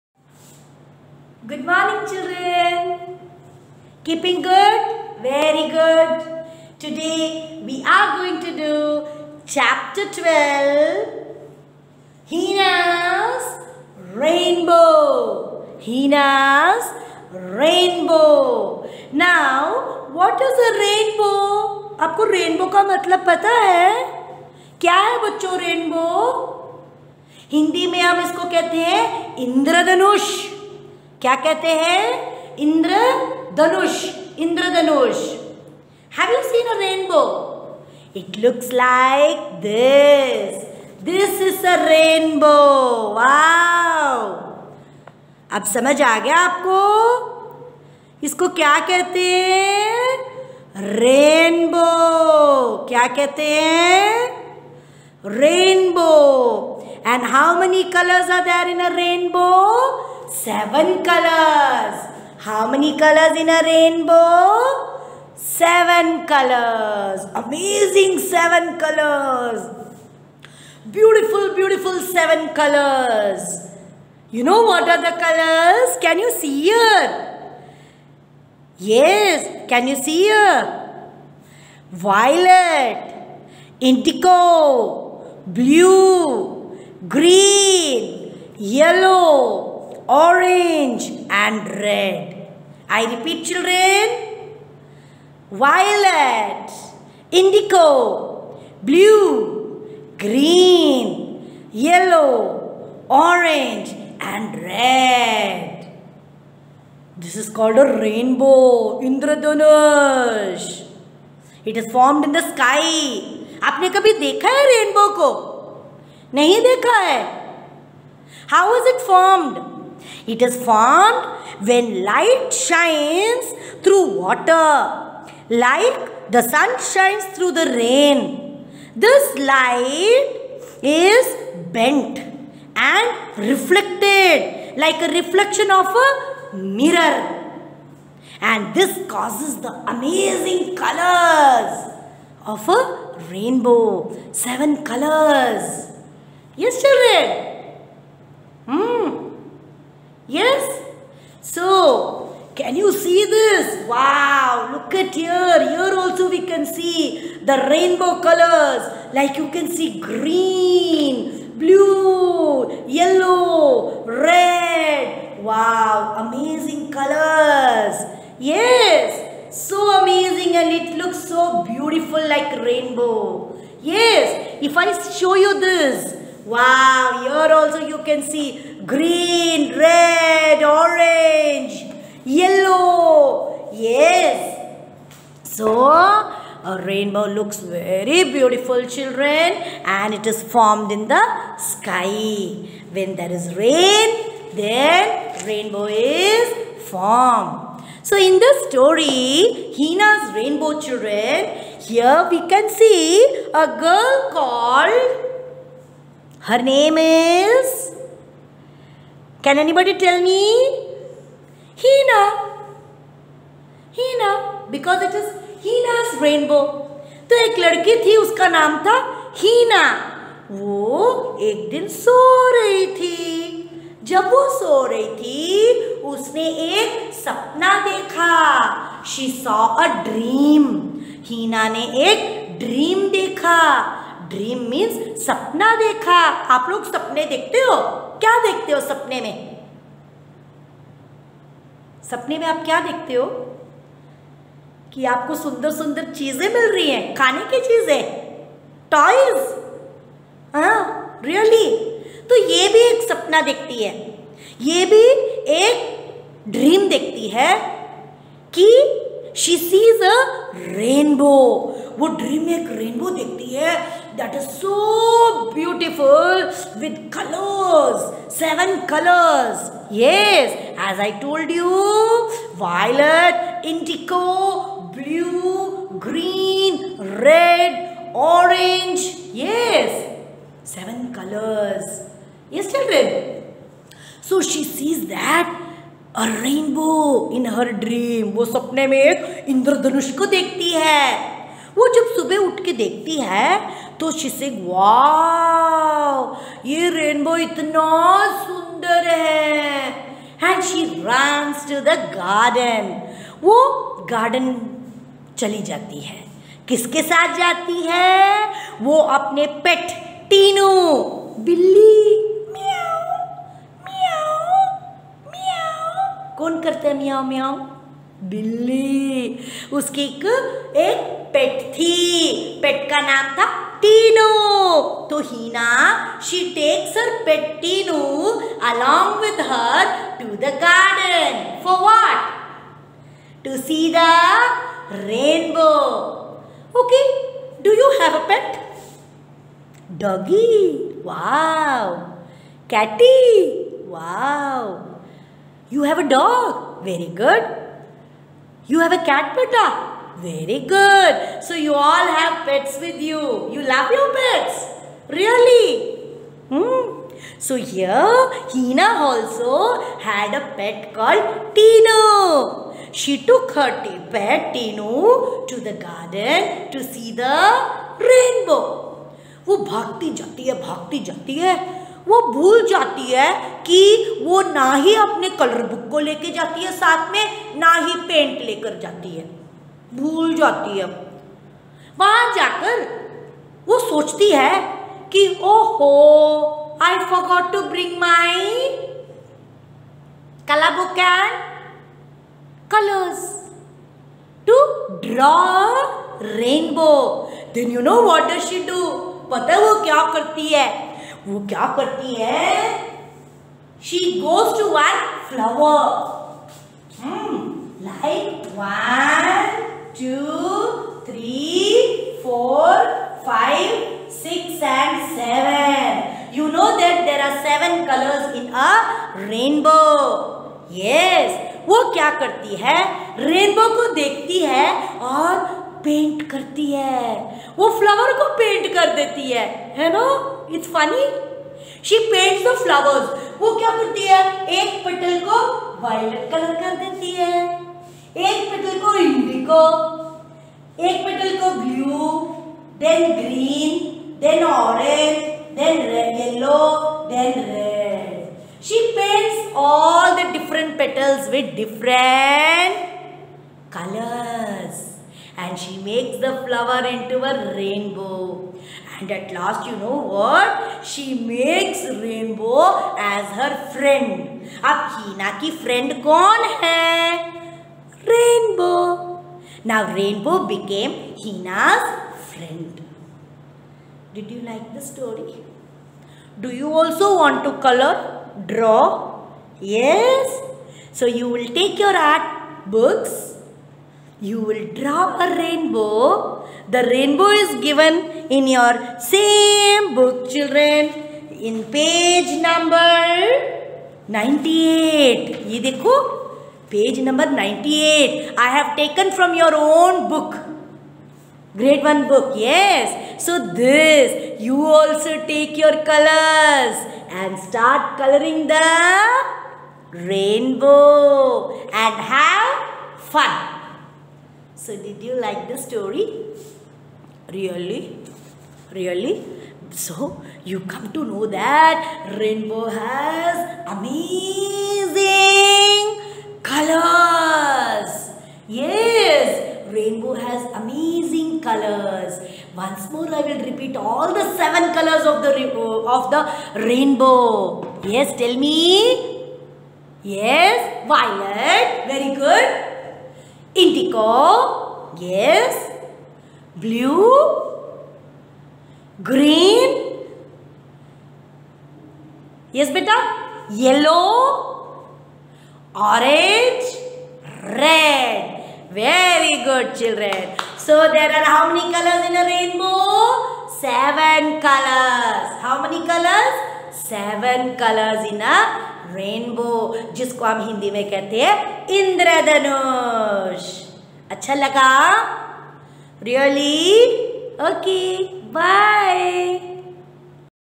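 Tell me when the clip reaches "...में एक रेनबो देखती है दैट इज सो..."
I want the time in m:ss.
4:22.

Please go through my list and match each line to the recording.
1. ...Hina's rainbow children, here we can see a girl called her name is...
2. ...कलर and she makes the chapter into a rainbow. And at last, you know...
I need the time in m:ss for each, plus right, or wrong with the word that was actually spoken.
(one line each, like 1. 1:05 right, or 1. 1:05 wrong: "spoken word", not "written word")
1. 3:19 right
2. 7:33 wrong: "flower", not "chapter".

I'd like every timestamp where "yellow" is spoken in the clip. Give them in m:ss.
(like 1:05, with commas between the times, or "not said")
1:28, 1:41, 2:42, 3:02, 9:13.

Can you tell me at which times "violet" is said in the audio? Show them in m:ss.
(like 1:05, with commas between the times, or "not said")
1:21, 1:35, 9:00.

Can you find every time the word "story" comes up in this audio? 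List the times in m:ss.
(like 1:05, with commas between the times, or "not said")
3:18, 7:54, 8:35.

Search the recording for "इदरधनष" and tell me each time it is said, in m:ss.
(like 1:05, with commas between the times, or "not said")
0:29, 0:34, 4:49, 9:31.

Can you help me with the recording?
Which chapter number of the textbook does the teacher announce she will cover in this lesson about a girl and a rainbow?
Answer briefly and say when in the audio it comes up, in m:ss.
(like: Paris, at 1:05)
12, at 0:09.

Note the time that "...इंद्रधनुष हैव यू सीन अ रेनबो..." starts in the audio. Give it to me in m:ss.
0:34.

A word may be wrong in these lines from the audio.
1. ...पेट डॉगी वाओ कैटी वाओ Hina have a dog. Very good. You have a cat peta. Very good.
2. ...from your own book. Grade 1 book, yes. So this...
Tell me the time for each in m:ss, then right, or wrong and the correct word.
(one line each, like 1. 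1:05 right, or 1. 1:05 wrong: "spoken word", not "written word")
1. 5:38 wrong: "You", not "Hina"
2. 8:19 right.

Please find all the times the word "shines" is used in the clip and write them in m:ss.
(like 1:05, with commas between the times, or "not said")
2:02, 2:06.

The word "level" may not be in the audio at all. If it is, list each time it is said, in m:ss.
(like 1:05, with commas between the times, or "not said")
not said.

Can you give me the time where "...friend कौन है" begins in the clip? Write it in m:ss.
7:45.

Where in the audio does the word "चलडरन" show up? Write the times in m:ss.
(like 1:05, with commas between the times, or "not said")
4:42.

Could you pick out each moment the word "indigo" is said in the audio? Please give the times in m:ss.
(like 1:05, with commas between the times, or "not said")
1:23, 1:37, 9:03.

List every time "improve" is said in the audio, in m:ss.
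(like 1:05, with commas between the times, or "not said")
not said.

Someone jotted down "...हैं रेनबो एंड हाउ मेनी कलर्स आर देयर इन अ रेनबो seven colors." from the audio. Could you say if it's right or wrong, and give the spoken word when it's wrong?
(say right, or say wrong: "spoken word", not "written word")
right.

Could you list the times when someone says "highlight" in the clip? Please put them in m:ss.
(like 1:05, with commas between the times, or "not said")
not said.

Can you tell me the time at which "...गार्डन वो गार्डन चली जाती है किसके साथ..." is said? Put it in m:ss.
5:02.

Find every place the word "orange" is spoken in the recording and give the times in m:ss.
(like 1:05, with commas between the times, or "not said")
1:30, 1:43, 3:00, 9:15.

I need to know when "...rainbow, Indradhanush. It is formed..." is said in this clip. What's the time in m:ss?
1:47.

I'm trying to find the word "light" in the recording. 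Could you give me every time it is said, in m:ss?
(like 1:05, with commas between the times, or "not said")
2:02, 2:09.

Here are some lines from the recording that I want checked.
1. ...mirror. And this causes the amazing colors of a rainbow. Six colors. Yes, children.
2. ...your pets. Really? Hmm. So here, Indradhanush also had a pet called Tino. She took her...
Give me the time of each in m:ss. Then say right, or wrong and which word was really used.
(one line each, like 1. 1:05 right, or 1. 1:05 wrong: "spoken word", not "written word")
1. 2:16 wrong: "Seven", not "Six"
2. 5:53 wrong: "Hina", not "Indradhanush".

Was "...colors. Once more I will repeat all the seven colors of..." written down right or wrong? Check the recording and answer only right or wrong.
right.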